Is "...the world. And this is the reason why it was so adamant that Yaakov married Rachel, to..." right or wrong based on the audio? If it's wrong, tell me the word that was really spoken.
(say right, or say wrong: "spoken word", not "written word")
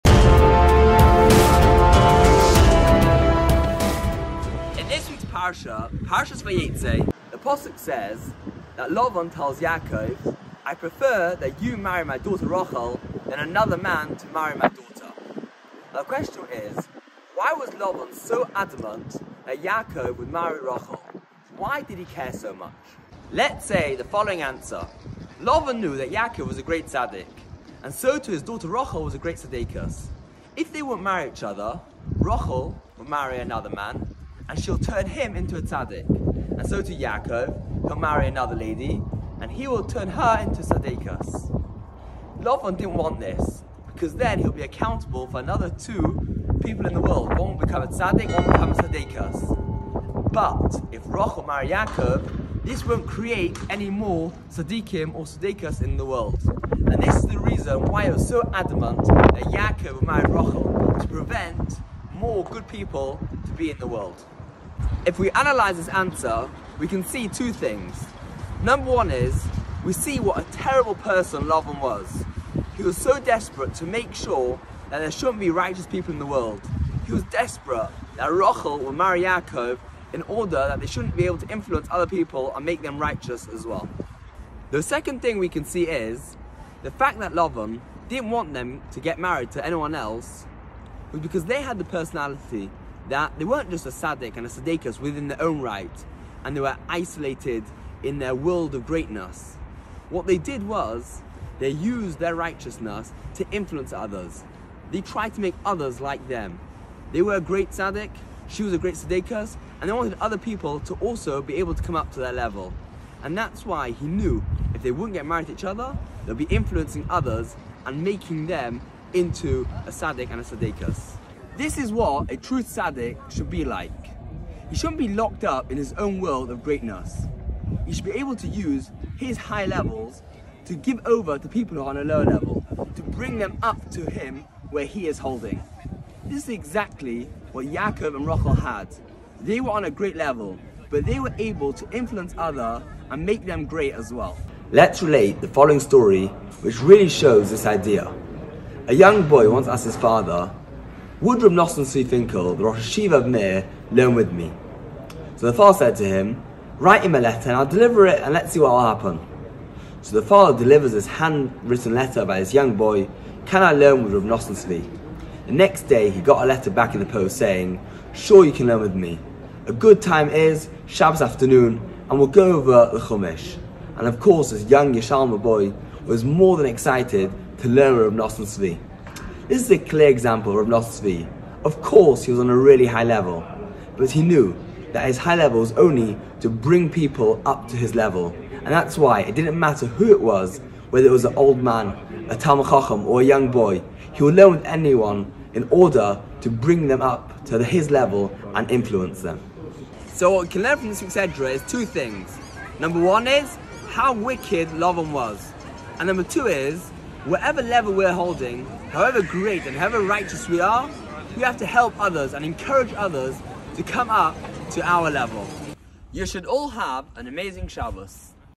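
right.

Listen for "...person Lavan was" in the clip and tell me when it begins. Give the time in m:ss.
1:10.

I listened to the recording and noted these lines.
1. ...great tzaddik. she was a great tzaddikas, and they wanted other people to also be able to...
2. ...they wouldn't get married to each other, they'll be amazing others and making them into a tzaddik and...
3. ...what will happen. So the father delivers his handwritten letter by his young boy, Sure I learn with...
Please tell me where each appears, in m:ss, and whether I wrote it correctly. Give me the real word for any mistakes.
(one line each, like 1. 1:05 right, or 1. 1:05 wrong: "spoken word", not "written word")
1. 1:47 right
2. 1:54 wrong: "influencing", not "amazing"
3. 2:38 wrong: "Can", not "Sure".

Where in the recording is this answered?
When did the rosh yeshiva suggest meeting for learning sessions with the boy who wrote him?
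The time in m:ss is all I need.
2:50.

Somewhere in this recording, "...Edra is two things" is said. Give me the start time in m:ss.
3:21.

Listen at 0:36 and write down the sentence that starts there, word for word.
And so to Yaakov, he'll marry another lady, and he will turn her into tzaddikas.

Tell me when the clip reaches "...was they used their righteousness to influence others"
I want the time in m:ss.
1:40.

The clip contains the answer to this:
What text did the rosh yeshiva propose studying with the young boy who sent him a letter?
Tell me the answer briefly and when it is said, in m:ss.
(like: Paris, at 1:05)
Chumash, at 2:53.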